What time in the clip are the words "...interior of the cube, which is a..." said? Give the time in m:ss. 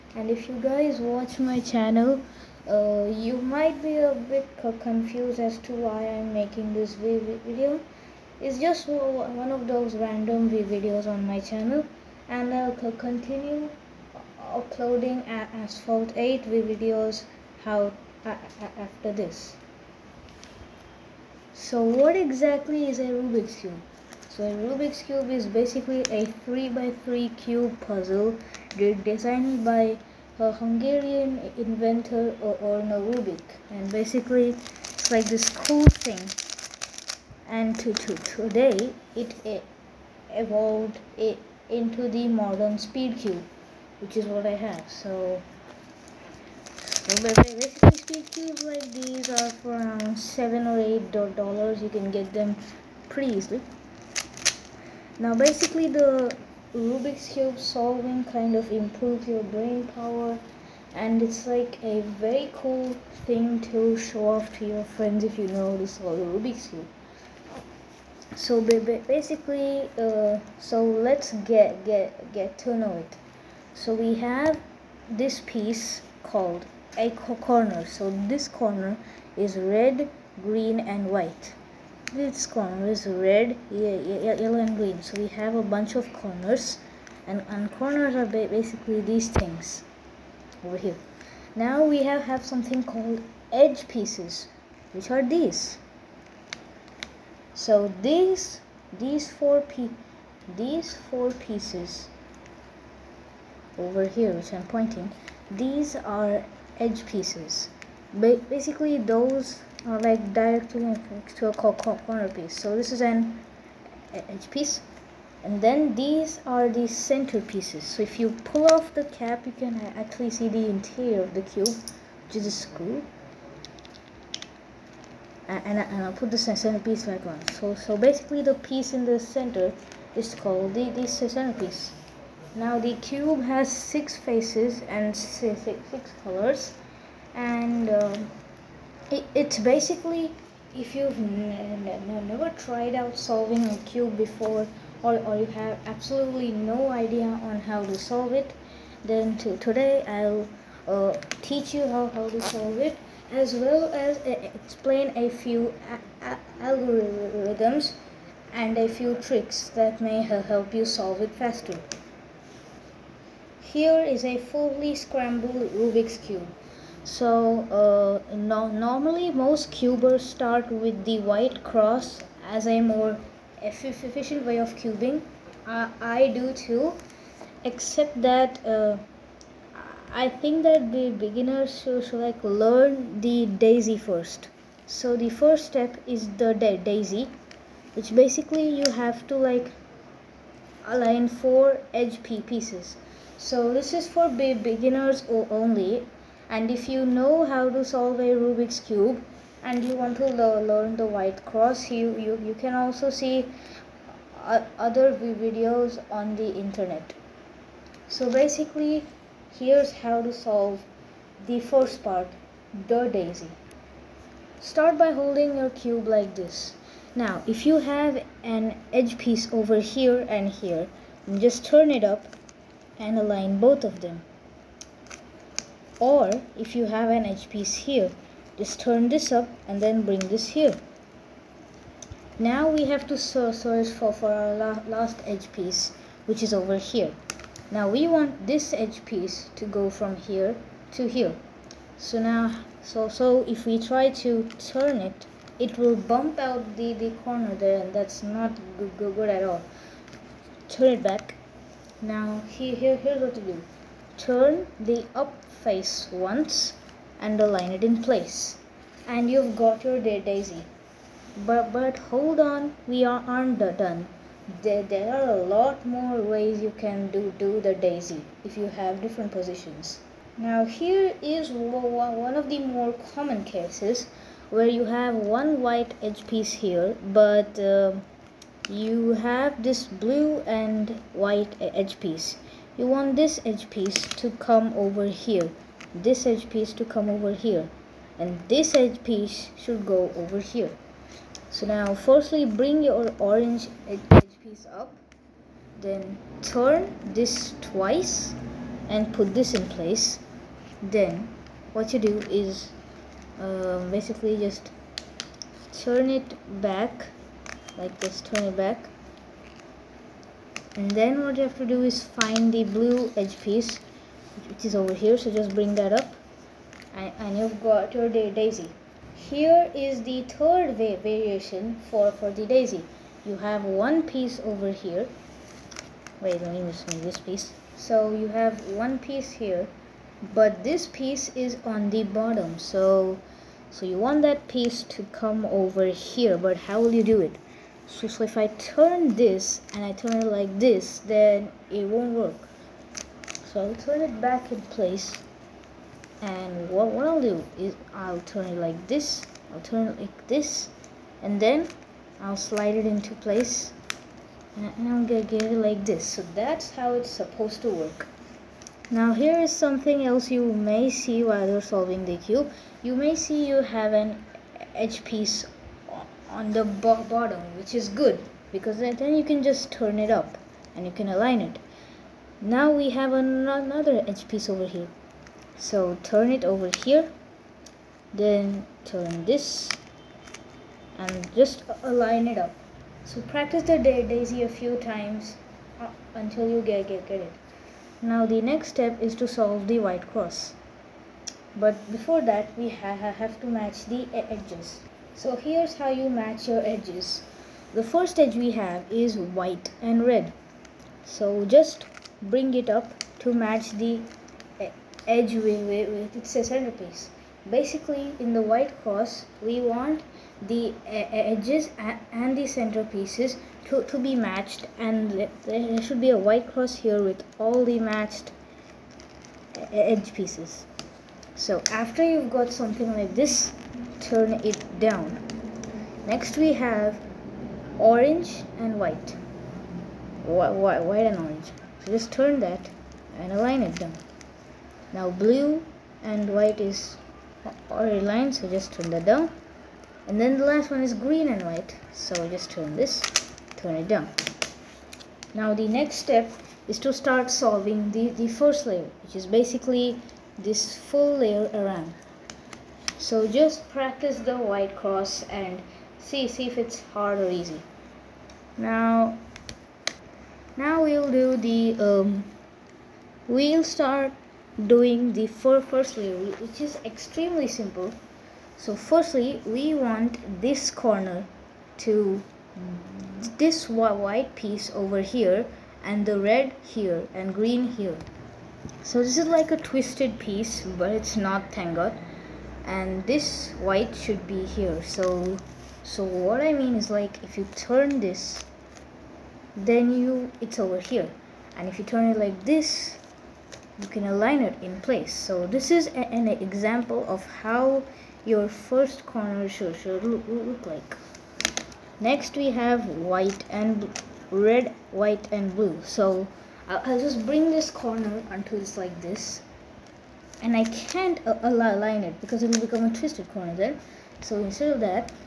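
2:00.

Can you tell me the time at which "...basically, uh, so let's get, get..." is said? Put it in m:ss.
1:08.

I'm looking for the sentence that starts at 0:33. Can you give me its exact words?
And basically it's like this cool thing.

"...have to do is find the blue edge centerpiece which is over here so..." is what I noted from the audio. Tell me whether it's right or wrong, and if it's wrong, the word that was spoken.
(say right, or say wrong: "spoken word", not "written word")
wrong: "piece", not "centerpiece".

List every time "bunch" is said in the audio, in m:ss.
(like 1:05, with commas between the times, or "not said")
1:25.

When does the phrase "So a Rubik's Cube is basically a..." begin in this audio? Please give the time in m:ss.
0:24.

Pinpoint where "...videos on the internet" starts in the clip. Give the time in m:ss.
3:25.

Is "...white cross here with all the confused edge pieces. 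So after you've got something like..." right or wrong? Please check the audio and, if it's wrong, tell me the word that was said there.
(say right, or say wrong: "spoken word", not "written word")
wrong: "matched", not "confused".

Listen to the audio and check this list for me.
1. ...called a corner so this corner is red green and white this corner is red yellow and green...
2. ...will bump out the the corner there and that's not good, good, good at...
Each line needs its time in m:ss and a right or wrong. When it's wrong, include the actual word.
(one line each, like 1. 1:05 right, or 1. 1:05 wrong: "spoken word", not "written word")
1. 1:16 right
2. 4:05 right.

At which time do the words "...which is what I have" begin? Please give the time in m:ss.
0:44.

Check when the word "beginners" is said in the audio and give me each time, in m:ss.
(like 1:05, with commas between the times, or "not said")
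3:01, 3:14.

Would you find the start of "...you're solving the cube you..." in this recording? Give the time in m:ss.
6:01.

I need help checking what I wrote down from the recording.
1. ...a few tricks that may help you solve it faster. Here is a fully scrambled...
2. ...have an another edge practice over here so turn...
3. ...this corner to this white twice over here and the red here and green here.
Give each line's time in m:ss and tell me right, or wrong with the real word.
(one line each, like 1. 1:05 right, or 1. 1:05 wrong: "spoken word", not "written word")
1. 2:38 right
2. 6:12 wrong: "piece", not "practice"
3. 7:50 wrong: "piece", not "twice".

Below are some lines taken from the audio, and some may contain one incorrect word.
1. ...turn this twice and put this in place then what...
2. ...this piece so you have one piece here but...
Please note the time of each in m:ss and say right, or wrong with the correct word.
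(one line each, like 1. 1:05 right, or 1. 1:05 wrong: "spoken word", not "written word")
1. 4:56 right
2. 5:27 right.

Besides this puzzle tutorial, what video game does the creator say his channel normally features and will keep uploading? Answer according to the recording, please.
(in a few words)
Asphalt 8.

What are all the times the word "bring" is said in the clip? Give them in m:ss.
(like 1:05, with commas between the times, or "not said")
3:50, 4:52, 5:15, 6:42, 8:27.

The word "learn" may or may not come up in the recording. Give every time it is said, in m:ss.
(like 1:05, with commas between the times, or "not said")
3:02, 3:20.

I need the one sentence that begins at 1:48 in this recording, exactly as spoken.
Ba basically, those are like directly next to a corner piece.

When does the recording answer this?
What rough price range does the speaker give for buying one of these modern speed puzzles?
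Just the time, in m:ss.
0:50.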